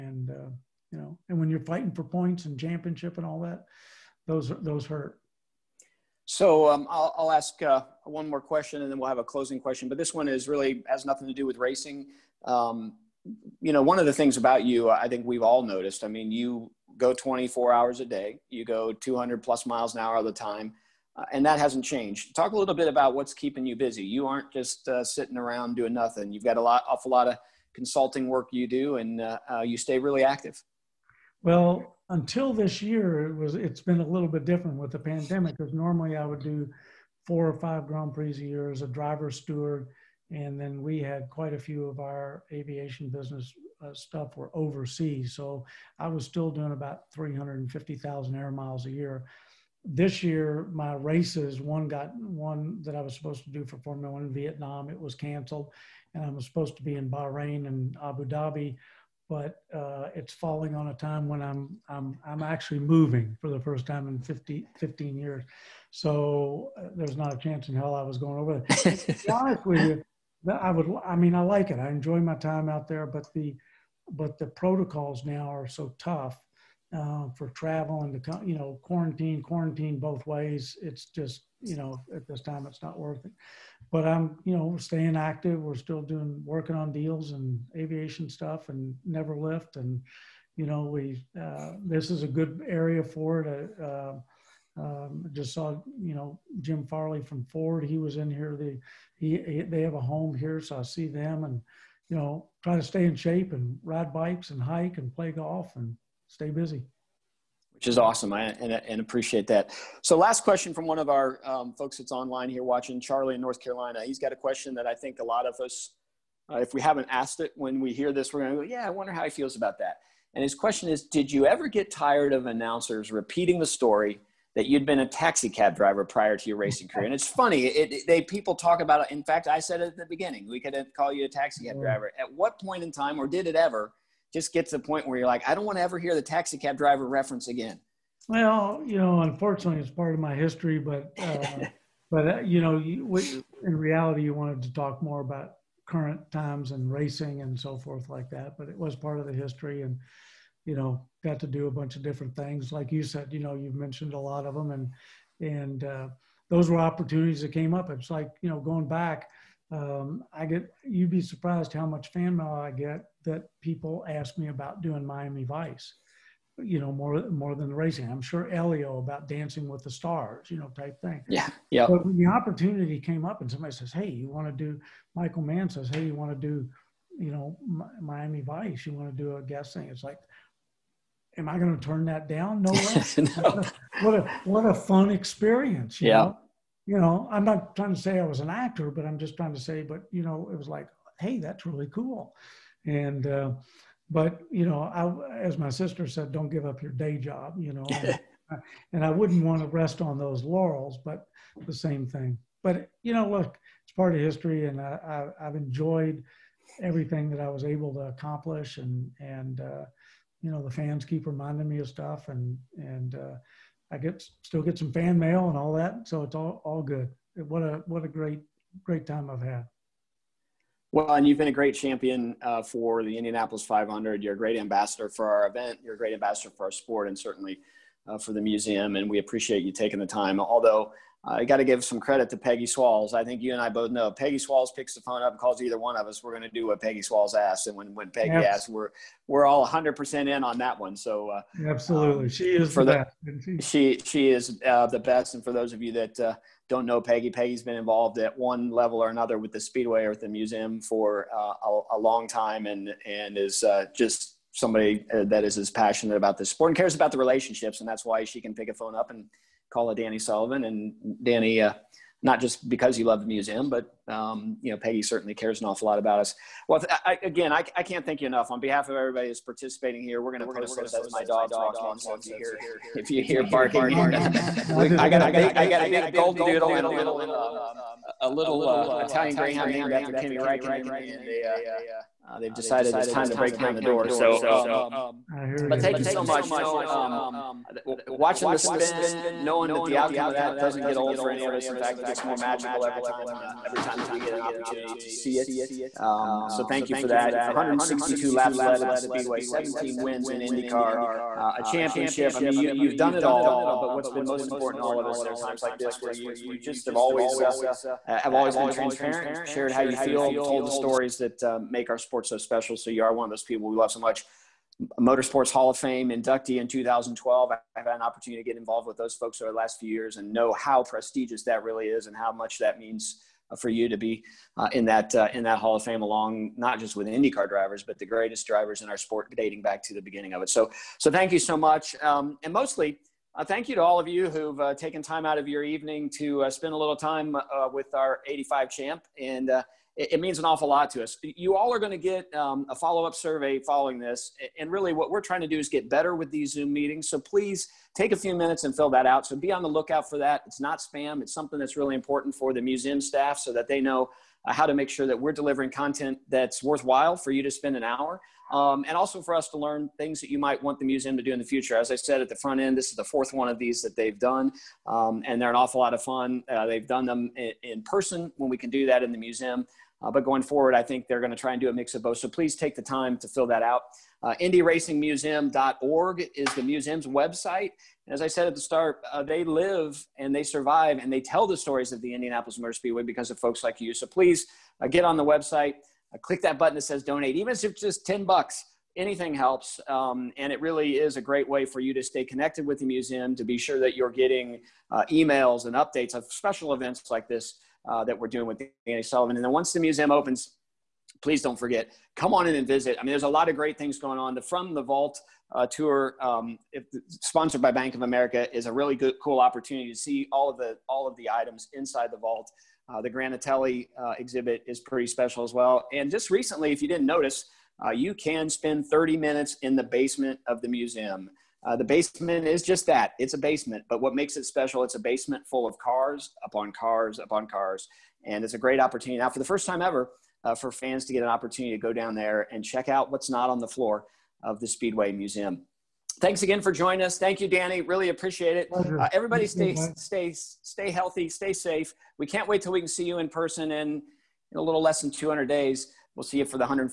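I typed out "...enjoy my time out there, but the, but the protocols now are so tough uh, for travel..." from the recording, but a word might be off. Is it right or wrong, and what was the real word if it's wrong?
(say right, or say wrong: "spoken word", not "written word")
right.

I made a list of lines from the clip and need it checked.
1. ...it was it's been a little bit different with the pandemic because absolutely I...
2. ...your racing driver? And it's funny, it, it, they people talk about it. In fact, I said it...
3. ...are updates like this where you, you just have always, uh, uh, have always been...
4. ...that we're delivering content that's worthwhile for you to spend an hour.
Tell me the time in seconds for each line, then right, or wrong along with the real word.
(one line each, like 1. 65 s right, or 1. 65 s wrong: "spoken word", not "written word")
1. 33 s wrong: "normally", not "absolutely"
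2. 126 s wrong: "career", not "driver"
3. 305 s wrong: "times", not "updates"
4. 355 s right.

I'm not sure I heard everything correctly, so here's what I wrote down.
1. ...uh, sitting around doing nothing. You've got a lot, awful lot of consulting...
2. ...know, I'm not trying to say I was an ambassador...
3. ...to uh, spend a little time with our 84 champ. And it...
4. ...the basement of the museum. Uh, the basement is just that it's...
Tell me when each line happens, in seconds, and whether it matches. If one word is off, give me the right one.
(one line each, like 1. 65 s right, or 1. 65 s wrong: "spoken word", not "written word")
1. 24 s right
2. 186 s wrong: "actor", not "ambassador"
3. 336 s wrong: "85", not "84"
4. 419 s right.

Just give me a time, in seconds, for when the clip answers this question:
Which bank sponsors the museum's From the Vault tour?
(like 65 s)
407 s.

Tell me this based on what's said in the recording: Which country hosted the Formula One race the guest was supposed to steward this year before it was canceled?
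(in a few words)
Vietnam.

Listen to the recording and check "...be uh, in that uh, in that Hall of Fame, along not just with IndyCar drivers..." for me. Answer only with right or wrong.
right.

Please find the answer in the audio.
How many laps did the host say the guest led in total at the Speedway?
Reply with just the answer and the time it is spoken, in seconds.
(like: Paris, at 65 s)
162, at 297 s.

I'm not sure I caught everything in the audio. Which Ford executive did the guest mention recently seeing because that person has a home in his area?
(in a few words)
Jim Farley.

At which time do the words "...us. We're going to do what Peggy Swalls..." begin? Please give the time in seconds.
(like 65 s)
236 s.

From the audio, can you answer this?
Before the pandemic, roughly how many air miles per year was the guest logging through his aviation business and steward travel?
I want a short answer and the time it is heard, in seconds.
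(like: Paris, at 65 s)
350,000, at 47 s.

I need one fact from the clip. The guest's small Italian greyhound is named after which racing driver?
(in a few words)
Kimi Räikkönen.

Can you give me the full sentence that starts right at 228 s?
And we appreciate you taking the time.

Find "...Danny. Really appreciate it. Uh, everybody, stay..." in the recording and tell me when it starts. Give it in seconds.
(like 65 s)
437 s.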